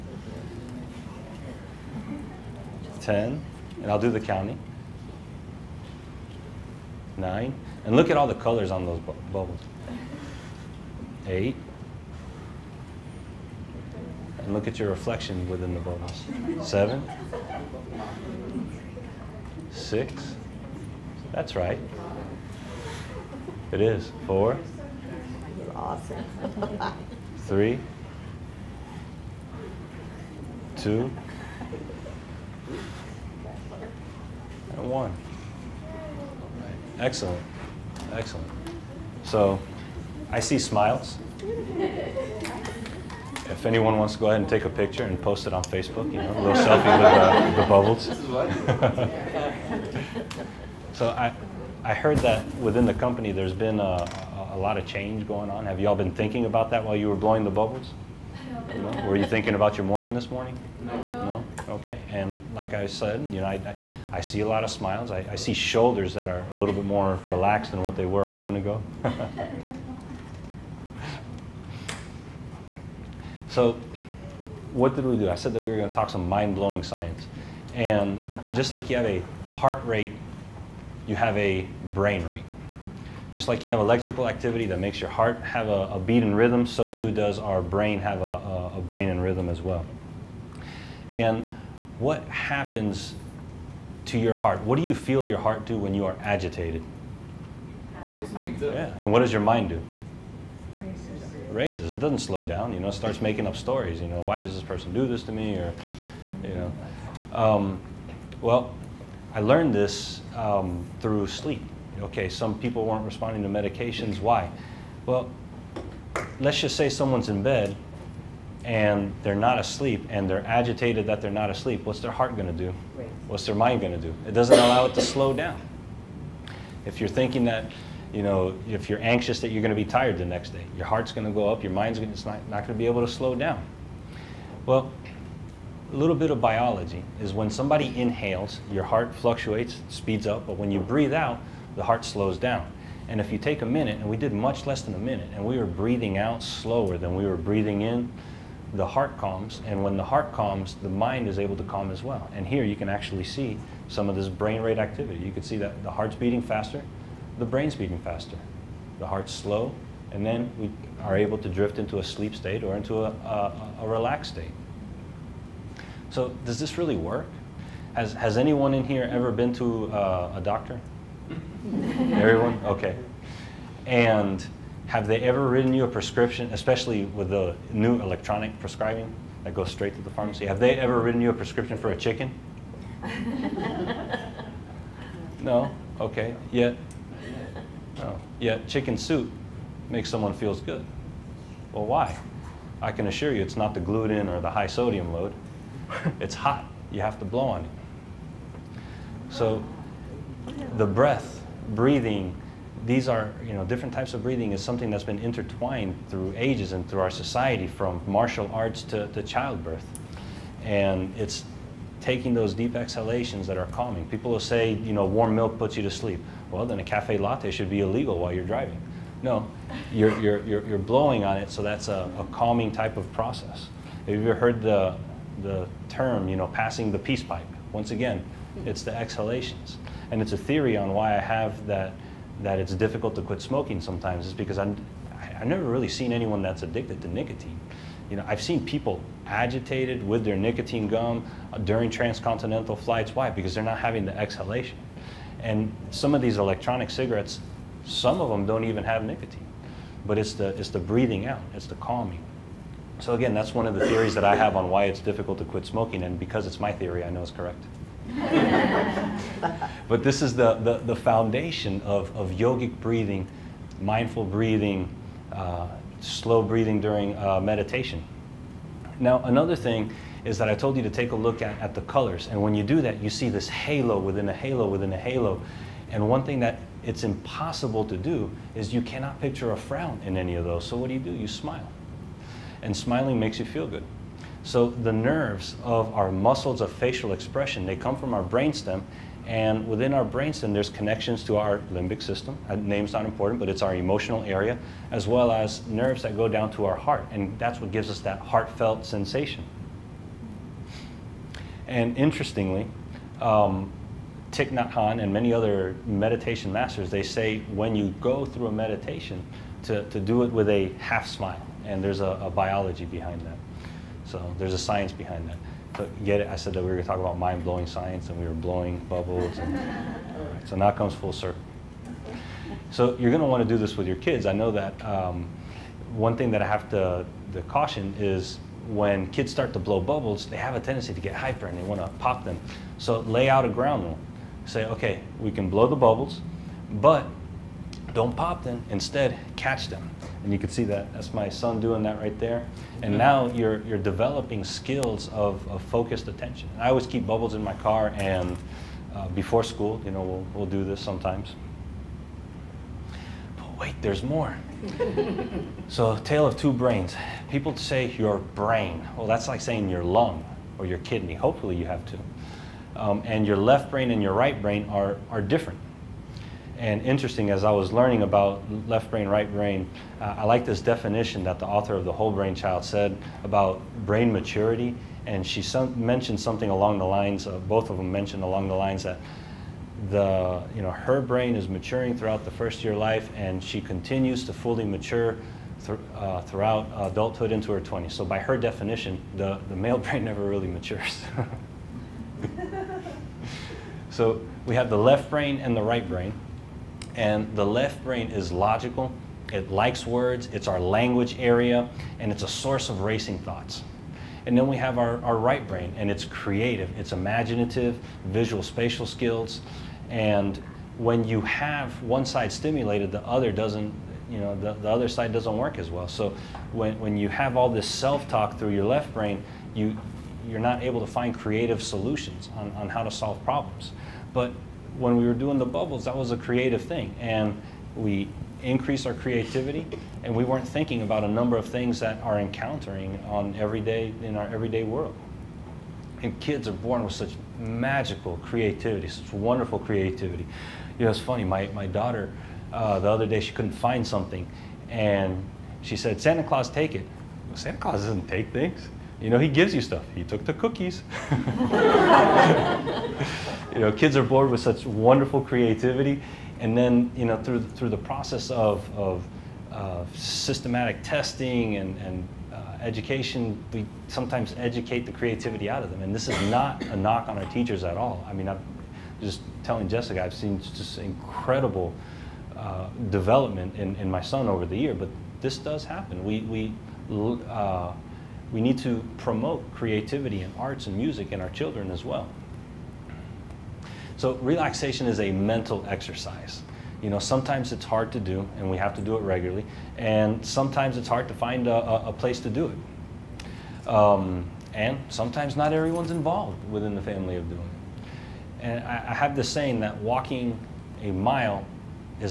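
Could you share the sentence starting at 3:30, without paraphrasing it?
And it's taking those deep exhalations that are calming.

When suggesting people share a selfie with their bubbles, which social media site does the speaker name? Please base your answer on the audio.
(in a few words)
Facebook.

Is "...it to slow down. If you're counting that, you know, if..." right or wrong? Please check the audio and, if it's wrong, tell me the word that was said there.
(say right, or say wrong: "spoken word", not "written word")
wrong: "thinking", not "counting".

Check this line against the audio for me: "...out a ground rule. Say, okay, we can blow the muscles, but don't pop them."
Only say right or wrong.
wrong.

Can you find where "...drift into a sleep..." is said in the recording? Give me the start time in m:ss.
2:41.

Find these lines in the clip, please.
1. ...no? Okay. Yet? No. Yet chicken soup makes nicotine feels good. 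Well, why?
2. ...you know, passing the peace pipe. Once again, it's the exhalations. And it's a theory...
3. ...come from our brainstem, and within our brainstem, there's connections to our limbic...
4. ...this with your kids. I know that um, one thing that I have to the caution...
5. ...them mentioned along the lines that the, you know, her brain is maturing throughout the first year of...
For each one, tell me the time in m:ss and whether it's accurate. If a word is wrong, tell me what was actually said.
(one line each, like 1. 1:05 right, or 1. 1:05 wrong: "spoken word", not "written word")
1. 3:05 wrong: "someone", not "nicotine"
2. 3:46 right
3. 4:47 right
4. 5:23 right
5. 6:17 right.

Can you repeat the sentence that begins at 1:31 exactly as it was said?
And what happens to your heart?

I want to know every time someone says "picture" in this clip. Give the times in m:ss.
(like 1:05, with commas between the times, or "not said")
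0:44, 4:39.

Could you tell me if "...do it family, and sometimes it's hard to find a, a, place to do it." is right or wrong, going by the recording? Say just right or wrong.
wrong.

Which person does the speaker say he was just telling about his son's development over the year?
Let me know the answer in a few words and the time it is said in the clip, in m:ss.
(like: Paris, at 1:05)
Jessica, at 7:49.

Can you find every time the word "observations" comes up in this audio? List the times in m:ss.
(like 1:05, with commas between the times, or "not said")
not said.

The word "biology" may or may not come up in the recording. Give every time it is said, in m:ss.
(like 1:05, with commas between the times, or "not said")
2:16, 5:12.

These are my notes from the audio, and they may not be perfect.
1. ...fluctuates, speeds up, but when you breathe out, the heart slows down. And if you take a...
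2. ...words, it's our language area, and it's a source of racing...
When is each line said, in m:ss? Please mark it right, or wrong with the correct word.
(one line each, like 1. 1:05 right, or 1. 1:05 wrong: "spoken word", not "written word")
1. 2:19 right
2. 6:39 right.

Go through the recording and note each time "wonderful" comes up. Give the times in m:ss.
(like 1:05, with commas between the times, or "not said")
7:19, 7:34.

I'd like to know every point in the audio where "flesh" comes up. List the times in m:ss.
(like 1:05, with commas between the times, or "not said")
not said.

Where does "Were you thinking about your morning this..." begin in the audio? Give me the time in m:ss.
0:59.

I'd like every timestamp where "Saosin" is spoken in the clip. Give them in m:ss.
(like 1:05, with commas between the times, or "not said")
not said.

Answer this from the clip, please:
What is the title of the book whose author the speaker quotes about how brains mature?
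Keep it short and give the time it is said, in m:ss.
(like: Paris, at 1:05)
The Whole Brain Child, at 6:11.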